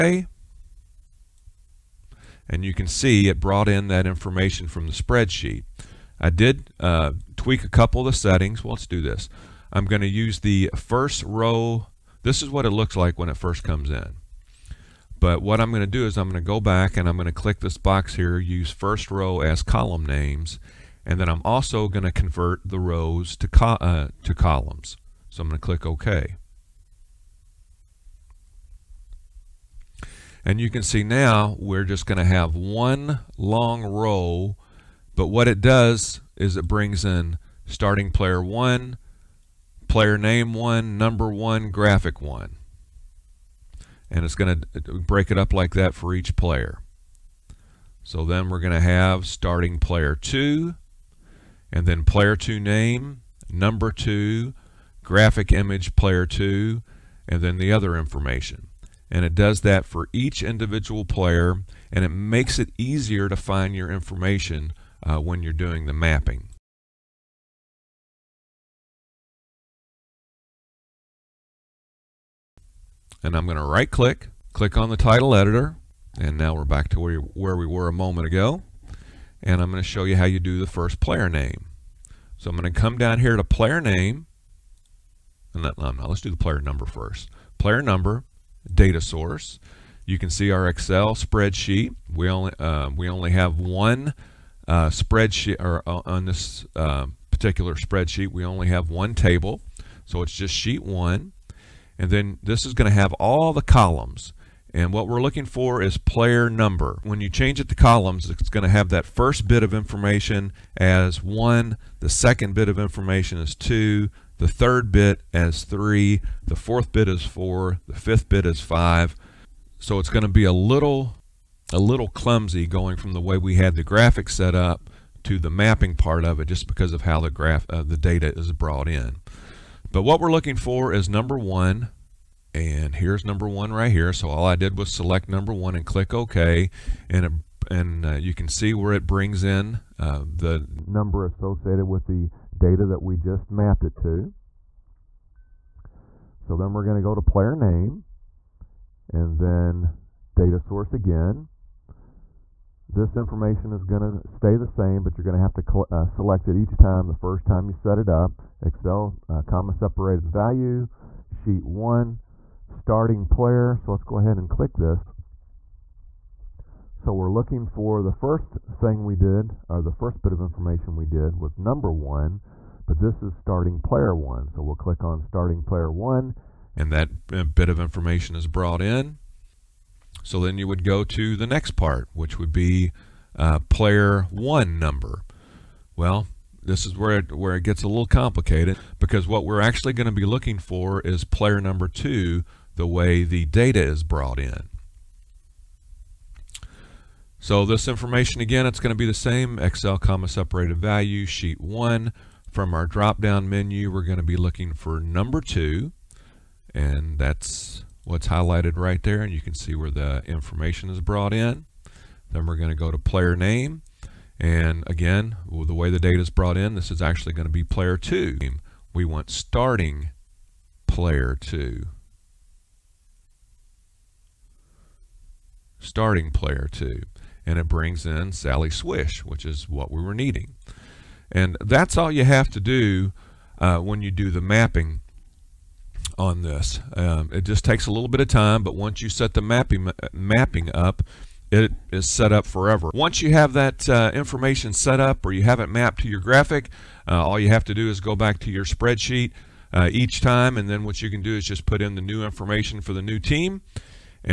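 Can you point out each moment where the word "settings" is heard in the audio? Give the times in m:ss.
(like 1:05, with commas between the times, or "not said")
0:08.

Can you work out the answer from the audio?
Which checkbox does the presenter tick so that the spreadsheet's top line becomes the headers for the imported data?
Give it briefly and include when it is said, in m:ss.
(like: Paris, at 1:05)
Use first row as column names, at 0:18.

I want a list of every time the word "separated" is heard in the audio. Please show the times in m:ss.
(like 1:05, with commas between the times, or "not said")
2:39, 3:20.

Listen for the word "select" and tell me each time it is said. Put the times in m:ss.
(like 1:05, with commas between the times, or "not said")
2:14, 2:36.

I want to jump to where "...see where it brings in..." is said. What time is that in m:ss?
2:18.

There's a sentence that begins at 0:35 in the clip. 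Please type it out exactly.
But what it does is it brings in starting player 1, player name 1, number 1, graphic 1.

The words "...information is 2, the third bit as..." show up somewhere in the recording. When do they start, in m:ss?
1:52.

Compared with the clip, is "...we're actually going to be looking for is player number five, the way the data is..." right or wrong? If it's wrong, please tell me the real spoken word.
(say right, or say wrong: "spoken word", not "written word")
wrong: "two", not "five".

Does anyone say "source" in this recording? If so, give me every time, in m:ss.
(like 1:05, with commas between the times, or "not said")
1:28, 2:30.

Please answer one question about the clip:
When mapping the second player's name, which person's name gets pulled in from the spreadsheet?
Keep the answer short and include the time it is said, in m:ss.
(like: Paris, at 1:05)
Sally Swish, at 3:48.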